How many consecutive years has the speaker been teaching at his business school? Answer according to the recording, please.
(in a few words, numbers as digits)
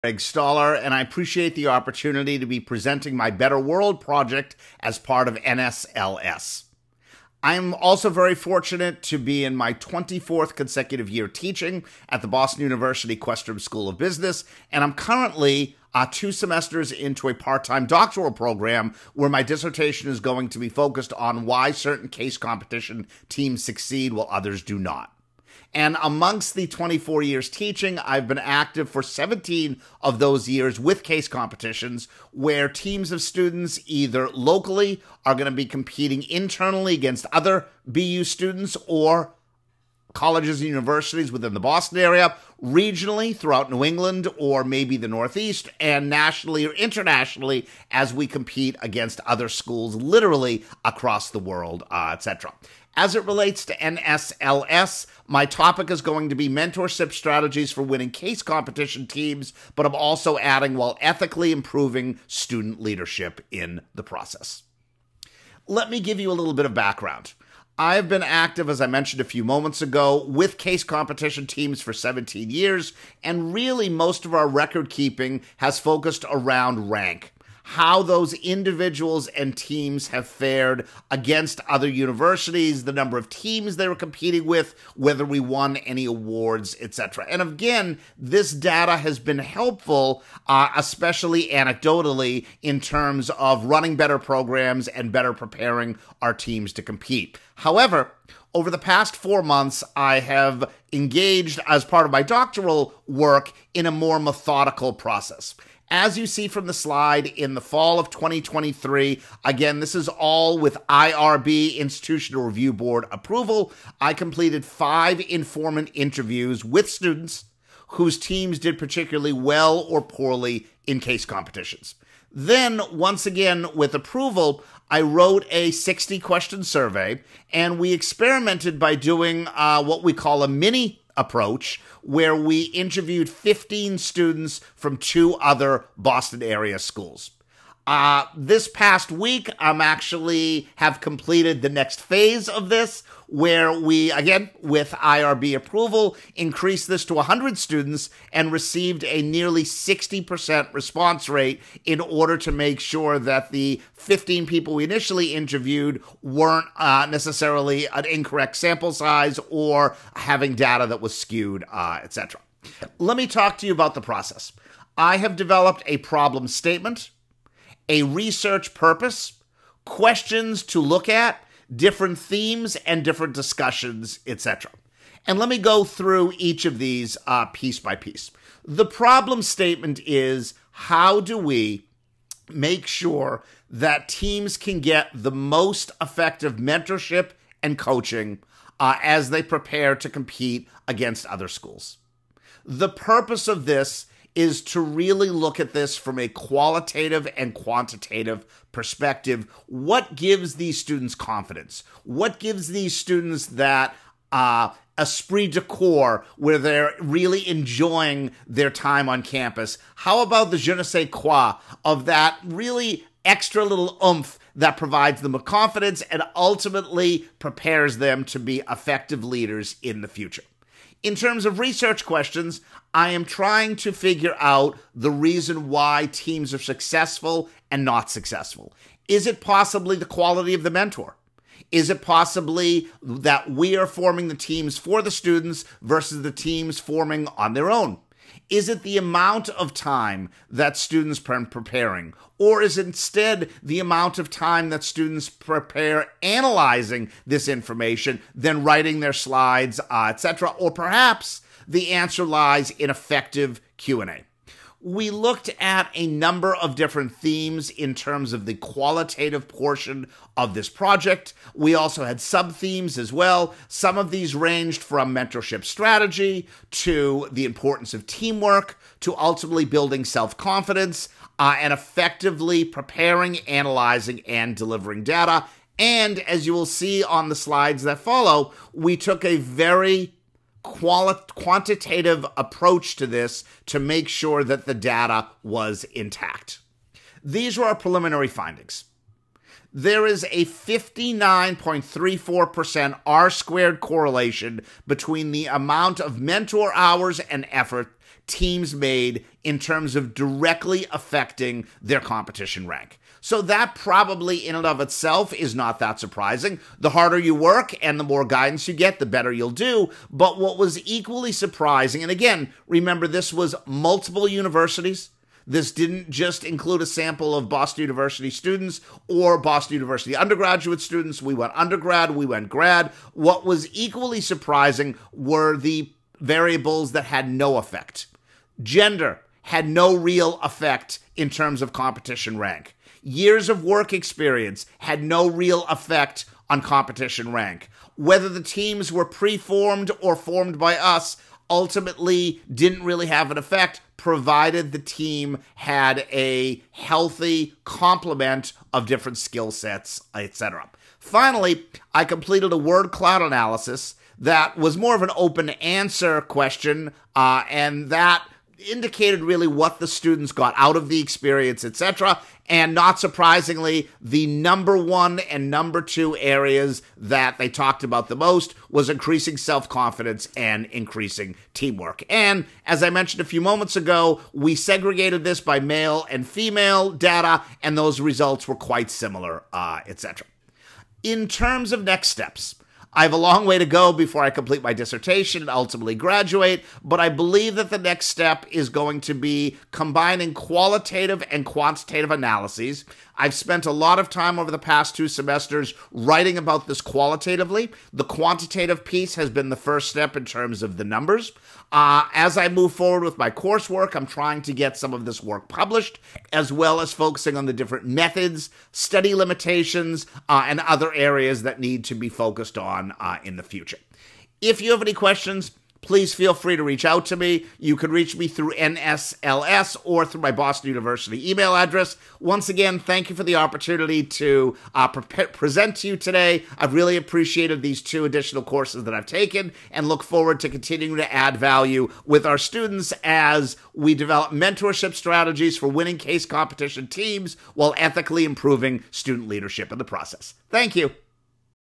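24th.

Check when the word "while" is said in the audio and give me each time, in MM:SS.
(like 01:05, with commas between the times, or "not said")
00:24, 01:00, 07:17.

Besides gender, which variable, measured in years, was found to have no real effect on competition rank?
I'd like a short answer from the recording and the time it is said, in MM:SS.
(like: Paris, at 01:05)
work experience, at 05:33.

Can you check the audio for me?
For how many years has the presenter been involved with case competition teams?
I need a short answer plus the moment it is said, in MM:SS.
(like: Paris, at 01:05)
17, at 00:29.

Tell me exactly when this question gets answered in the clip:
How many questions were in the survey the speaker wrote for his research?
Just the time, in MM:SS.
02:05.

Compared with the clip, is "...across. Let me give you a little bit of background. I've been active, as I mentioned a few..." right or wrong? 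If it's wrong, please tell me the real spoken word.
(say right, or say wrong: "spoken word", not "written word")
wrong: "process", not "across".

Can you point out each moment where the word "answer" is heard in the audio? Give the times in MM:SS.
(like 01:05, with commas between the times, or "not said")
04:11, 05:55.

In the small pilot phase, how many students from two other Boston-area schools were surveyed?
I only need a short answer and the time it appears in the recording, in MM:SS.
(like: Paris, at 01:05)
15, at 02:13.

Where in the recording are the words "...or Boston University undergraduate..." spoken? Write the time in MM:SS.
05:19.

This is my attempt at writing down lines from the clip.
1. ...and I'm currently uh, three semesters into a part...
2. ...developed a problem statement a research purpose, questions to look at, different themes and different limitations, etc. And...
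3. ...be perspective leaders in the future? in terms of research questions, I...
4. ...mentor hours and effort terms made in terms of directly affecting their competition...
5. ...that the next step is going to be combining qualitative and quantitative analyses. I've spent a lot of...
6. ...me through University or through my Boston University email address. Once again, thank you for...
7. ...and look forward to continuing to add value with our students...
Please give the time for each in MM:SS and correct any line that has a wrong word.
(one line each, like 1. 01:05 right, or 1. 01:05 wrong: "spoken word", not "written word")
1. 00:14 wrong: "two", not "three"
2. 02:45 wrong: "discussions", not "limitations"
3. 03:38 wrong: "effective", not "perspective"
4. 04:56 wrong: "teams", not "terms"
5. 06:27 right
6. 06:58 wrong: "NSLS", not "University"
7. 07:09 right.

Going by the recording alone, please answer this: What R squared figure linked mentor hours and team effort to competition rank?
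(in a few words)
59.34%.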